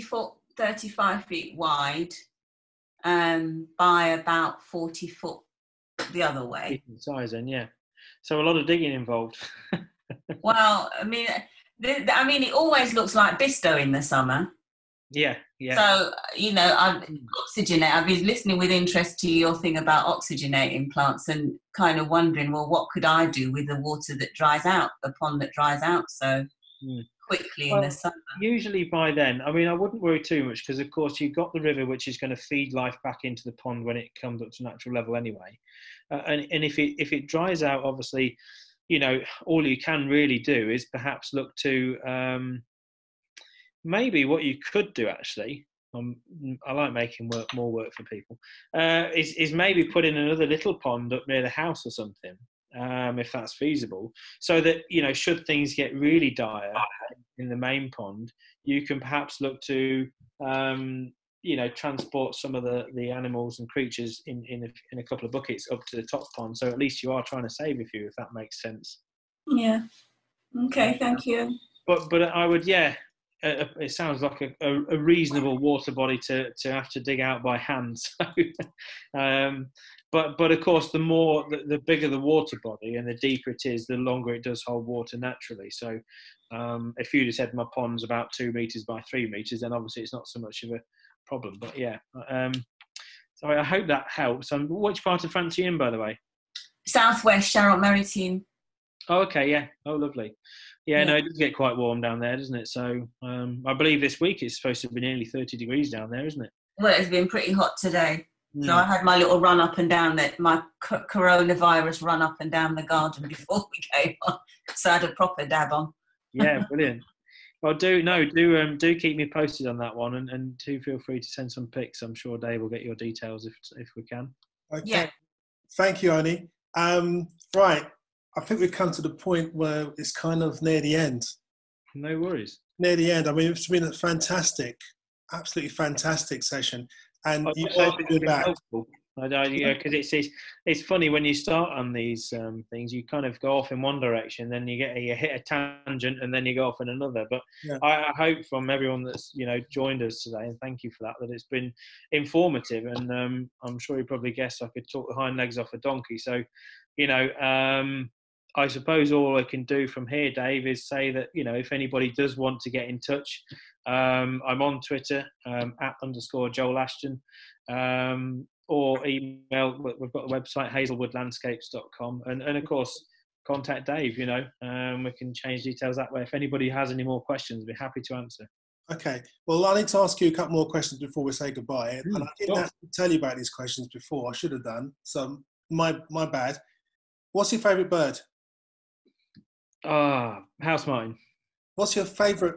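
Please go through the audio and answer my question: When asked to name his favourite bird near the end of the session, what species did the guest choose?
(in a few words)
House martin.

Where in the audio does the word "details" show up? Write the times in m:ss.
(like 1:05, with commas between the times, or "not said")
2:02, 2:55.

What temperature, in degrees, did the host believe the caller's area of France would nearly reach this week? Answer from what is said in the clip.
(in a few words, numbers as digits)
30.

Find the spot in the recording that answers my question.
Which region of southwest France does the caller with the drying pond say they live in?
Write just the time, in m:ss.
1:37.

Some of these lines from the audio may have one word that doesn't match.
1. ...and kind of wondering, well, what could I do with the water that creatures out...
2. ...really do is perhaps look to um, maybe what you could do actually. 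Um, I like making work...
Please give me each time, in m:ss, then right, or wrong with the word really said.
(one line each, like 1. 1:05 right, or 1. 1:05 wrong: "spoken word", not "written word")
1. 0:21 wrong: "dries", not "creatures"
2. 0:40 right.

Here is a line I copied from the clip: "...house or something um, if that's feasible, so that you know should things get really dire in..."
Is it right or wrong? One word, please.
right.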